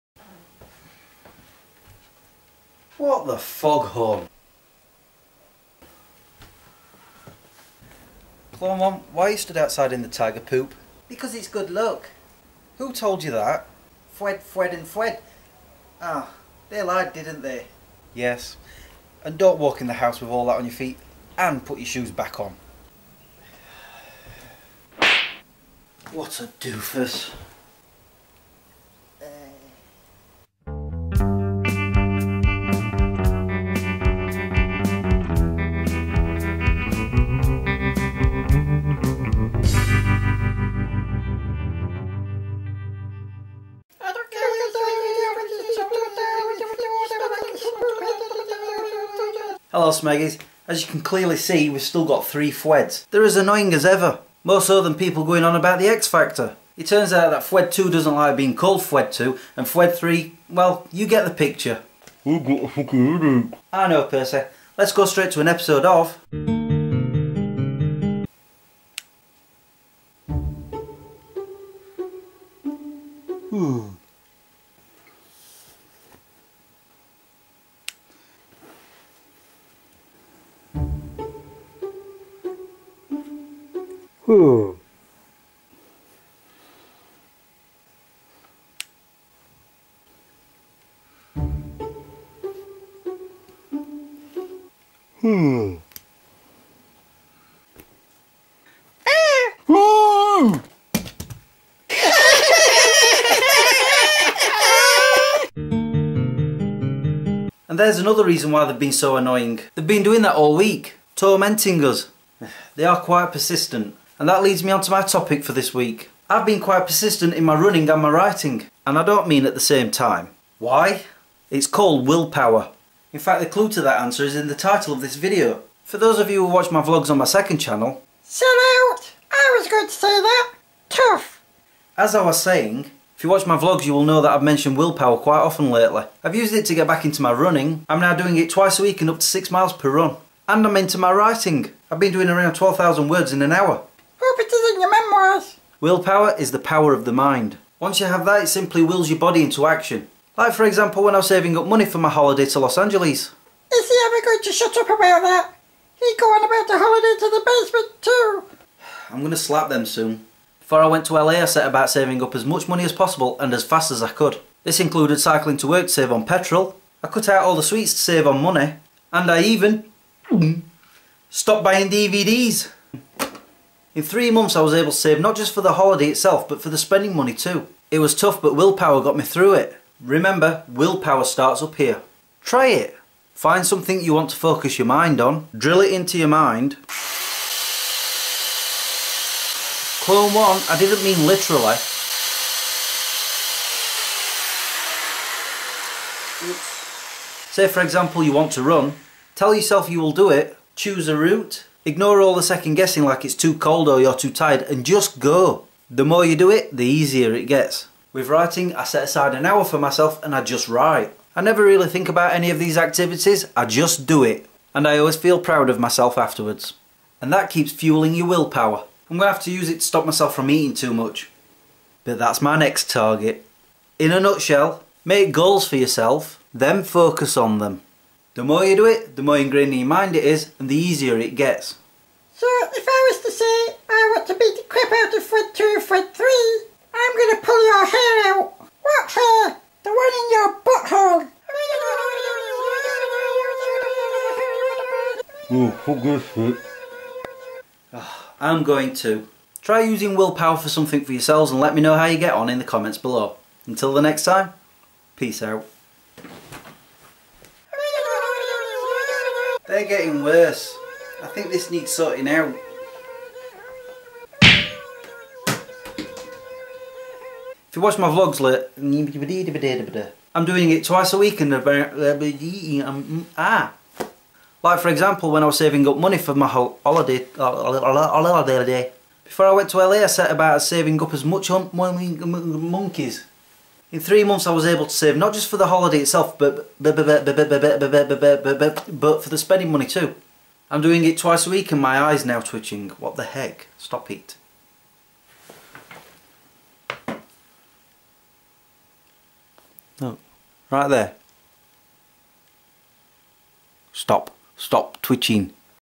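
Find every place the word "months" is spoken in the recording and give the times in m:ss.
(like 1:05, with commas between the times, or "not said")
2:54, 4:44.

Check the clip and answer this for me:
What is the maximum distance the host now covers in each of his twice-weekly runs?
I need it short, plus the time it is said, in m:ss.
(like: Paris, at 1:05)
6 miles, at 2:19.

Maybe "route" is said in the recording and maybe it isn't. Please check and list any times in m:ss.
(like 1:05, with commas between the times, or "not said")
3:21.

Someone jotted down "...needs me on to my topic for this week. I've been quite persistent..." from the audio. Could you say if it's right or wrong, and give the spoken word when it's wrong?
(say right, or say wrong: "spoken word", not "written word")
wrong: "leads", not "needs".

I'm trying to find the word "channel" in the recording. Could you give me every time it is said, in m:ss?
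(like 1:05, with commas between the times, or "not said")
2:07.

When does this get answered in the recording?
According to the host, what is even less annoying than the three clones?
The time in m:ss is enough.
0:55.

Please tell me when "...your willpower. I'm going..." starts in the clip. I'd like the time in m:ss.
3:38.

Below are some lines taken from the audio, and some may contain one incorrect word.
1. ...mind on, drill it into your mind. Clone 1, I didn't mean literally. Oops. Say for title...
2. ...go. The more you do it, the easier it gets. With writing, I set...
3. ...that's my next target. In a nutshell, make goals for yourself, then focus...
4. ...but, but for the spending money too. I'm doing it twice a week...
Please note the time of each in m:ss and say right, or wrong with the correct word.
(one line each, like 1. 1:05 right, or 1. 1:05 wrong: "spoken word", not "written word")
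1. 3:04 wrong: "example", not "title"
2. 3:25 right
3. 3:42 right
4. 4:46 right.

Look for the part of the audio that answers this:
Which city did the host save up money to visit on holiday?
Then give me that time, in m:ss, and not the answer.
2:32.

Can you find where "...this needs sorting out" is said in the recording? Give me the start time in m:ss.
4:21.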